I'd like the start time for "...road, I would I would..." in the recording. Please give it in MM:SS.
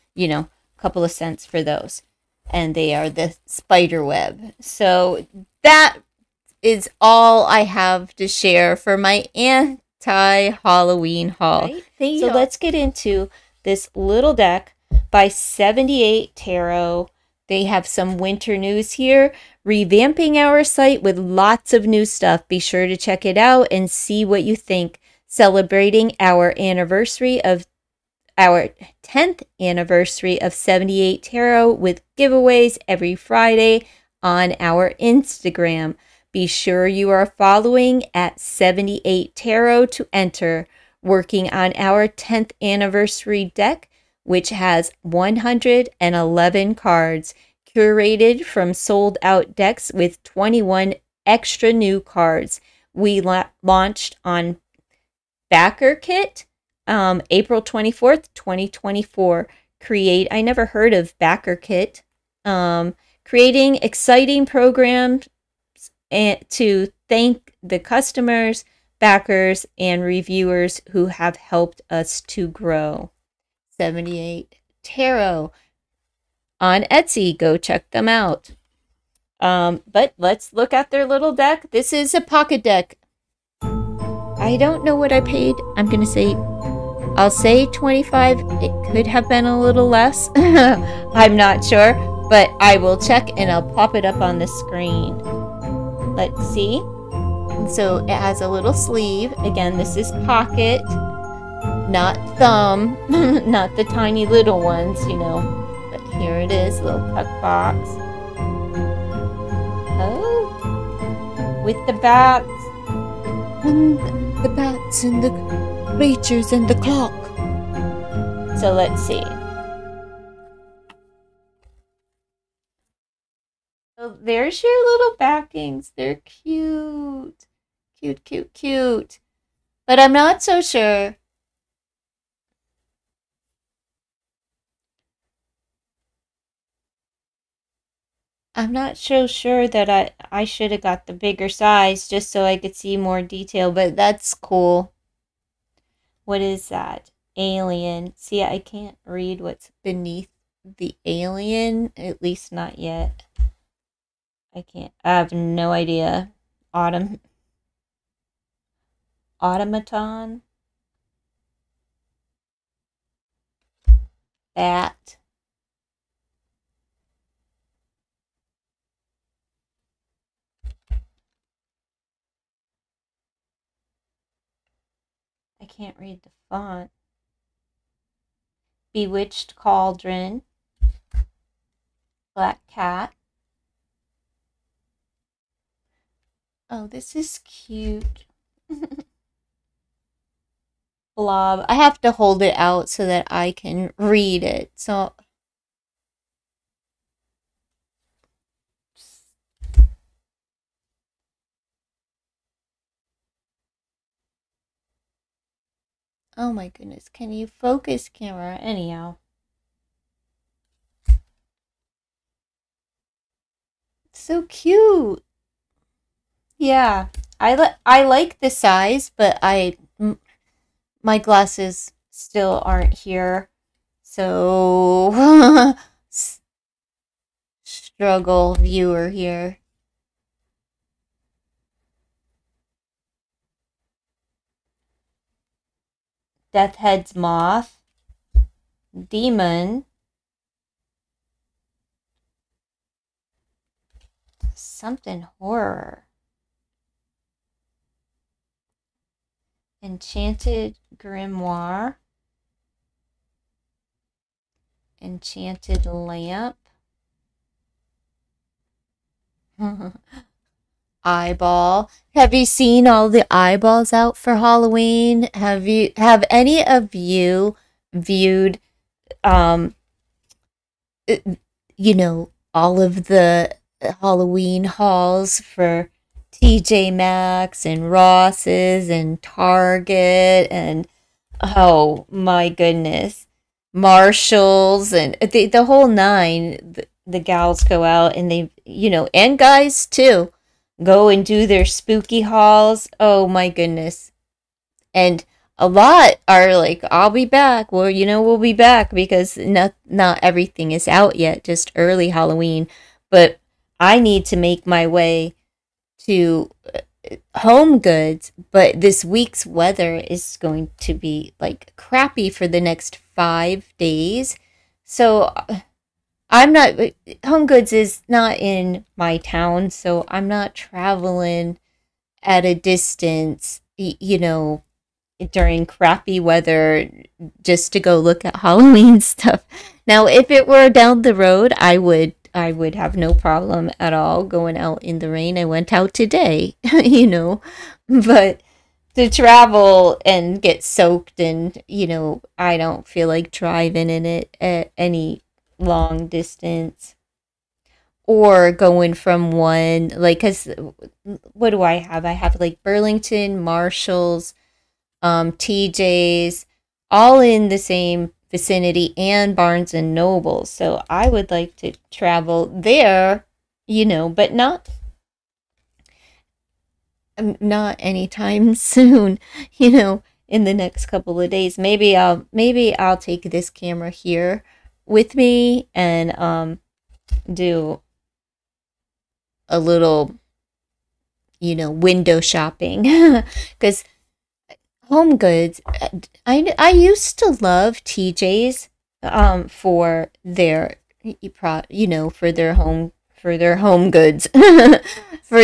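05:31.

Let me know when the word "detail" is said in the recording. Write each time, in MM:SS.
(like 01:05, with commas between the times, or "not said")
02:23.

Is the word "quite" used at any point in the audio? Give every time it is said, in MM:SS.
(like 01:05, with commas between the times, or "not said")
not said.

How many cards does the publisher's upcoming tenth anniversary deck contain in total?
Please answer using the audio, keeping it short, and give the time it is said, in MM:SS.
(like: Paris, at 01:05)
111, at 00:45.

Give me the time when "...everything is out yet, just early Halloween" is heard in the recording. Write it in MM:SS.
05:00.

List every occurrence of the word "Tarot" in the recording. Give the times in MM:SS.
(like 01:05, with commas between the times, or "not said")
00:16, 00:31, 00:39, 01:14.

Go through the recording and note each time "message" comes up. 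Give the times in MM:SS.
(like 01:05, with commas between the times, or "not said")
not said.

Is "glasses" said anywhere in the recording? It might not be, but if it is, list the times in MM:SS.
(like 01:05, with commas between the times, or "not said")
03:41.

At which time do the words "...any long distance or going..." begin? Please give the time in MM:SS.
05:44.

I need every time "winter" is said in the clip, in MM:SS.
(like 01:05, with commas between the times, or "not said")
00:18.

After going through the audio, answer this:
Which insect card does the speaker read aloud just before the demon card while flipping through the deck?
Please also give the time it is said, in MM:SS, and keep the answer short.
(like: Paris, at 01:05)
Deathhead's moth, at 03:56.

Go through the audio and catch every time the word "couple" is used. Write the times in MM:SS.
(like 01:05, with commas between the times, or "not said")
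00:00, 06:10.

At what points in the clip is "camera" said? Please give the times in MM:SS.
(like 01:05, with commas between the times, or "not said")
03:28, 06:13.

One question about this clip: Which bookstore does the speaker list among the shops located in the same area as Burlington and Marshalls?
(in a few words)
Barnes and Noble.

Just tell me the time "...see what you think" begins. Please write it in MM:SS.
00:23.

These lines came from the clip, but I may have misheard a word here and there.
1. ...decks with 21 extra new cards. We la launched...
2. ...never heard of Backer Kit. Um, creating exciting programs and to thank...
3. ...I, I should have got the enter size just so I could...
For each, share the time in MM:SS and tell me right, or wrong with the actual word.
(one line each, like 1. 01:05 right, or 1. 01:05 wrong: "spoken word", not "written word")
1. 00:49 right
2. 01:00 right
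3. 02:19 wrong: "bigger", not "enter".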